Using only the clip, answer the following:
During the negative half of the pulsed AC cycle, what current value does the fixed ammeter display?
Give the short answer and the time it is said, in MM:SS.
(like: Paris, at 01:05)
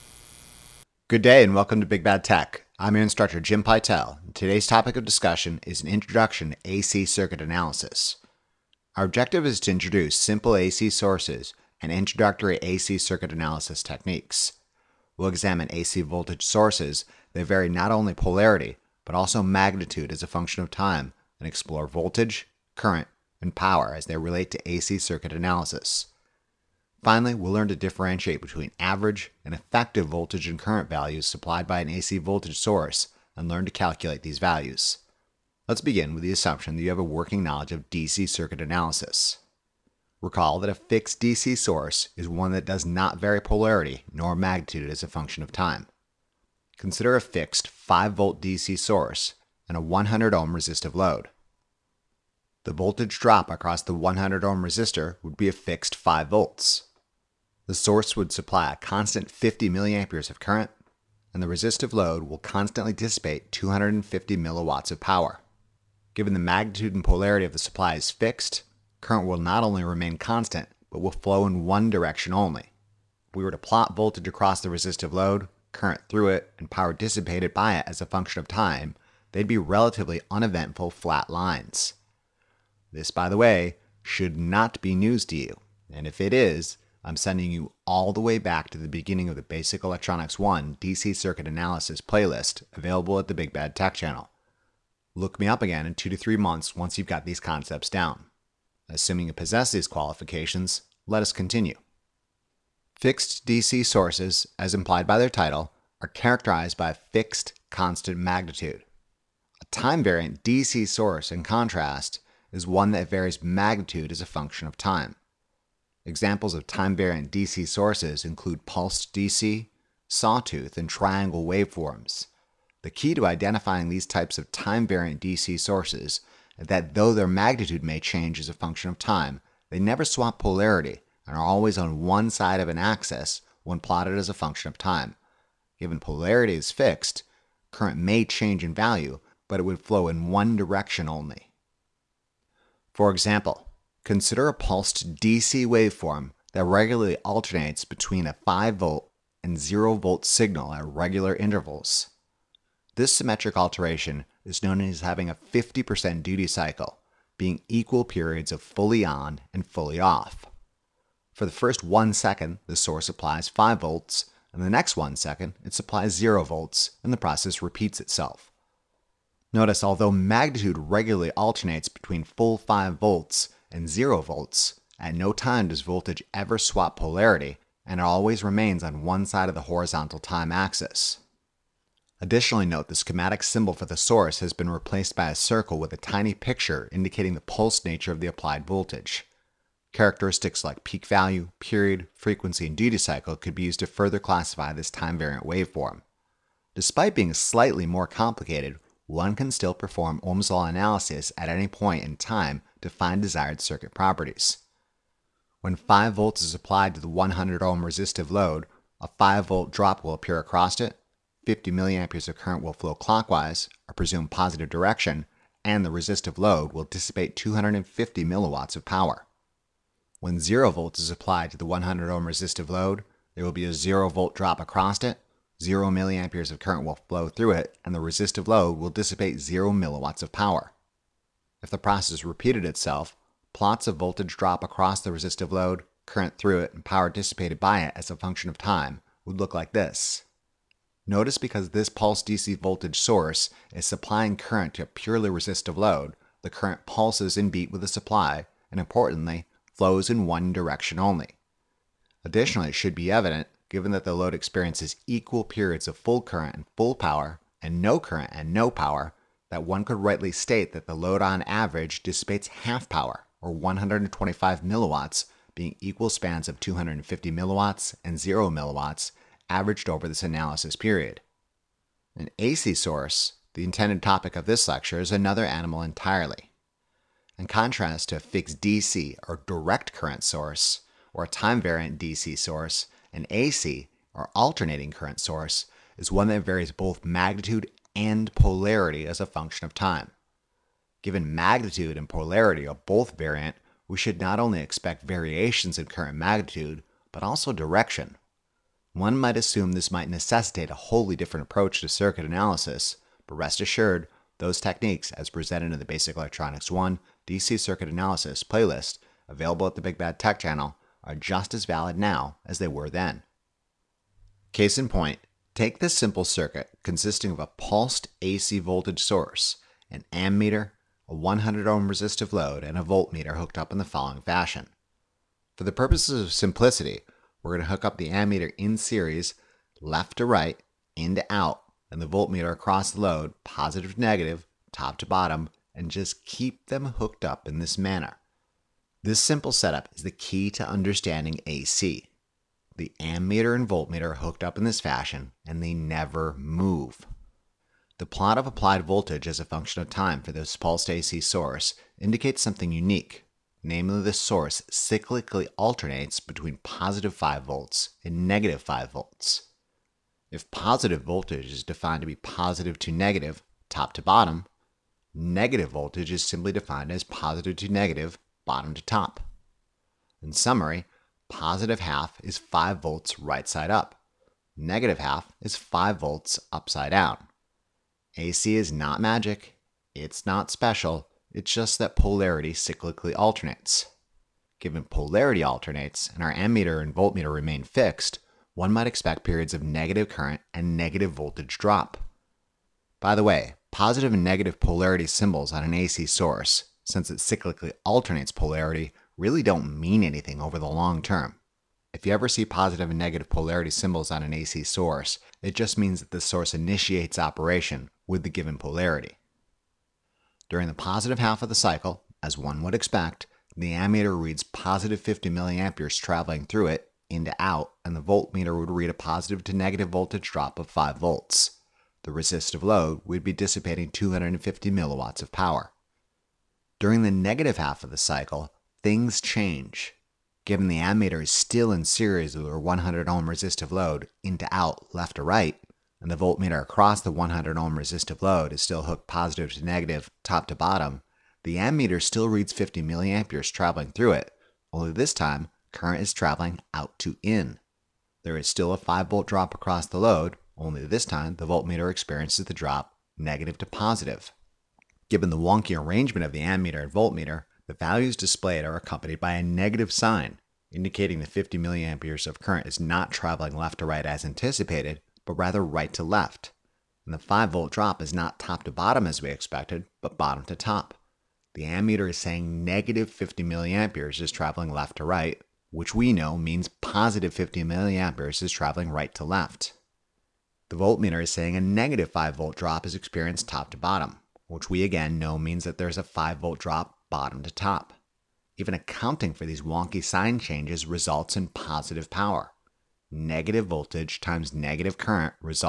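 -50 milliamperes, at 07:52.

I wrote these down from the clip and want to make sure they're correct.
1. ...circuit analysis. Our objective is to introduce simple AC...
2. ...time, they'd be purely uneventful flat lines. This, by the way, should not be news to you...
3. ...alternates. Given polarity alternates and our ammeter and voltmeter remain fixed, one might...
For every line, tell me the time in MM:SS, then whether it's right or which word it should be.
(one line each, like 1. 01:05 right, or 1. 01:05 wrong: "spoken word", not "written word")
1. 00:07 right
2. 01:18 wrong: "relatively", not "purely"
3. 06:23 right.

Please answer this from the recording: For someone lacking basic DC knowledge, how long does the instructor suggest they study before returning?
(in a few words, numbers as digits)
2 to 3 months.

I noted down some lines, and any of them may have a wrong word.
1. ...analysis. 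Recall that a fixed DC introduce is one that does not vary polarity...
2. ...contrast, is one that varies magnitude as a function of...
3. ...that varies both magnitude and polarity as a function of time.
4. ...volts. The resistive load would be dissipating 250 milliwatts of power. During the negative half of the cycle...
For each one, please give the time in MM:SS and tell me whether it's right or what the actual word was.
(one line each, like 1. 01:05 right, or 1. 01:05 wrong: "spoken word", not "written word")
1. 00:38 wrong: "source", not "introduce"
2. 01:51 right
3. 04:46 right
4. 07:00 right.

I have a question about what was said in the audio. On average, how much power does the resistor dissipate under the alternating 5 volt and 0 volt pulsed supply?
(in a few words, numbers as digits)
125 milliwatts.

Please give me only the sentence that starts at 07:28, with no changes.
There is still a 5 volt drop across the load, only this time the voltmeter experiences the drop negative to positive.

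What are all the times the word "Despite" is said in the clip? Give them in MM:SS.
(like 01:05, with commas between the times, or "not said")
03:16.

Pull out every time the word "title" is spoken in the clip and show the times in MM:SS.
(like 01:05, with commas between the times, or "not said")
01:45.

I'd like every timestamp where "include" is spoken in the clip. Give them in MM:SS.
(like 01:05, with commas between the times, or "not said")
01:58.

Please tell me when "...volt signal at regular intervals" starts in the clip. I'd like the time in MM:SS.
02:29.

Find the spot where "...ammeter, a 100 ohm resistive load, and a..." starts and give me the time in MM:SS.
05:20.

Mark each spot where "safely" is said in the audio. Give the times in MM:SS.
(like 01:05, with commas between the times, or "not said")
not said.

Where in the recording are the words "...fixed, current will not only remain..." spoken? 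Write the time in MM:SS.
01:08.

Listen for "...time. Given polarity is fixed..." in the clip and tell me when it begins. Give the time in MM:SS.
02:14.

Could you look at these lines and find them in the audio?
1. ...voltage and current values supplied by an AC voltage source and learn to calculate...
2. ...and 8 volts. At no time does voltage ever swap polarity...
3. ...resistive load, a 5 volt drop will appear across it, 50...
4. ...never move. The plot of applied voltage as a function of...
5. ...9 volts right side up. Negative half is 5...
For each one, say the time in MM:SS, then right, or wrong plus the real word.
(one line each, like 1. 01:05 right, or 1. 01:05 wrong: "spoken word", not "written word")
1. 00:30 right
2. 02:53 wrong: "0", not "8"
3. 03:27 right
4. 05:45 right
5. 06:12 wrong: "5", not "9".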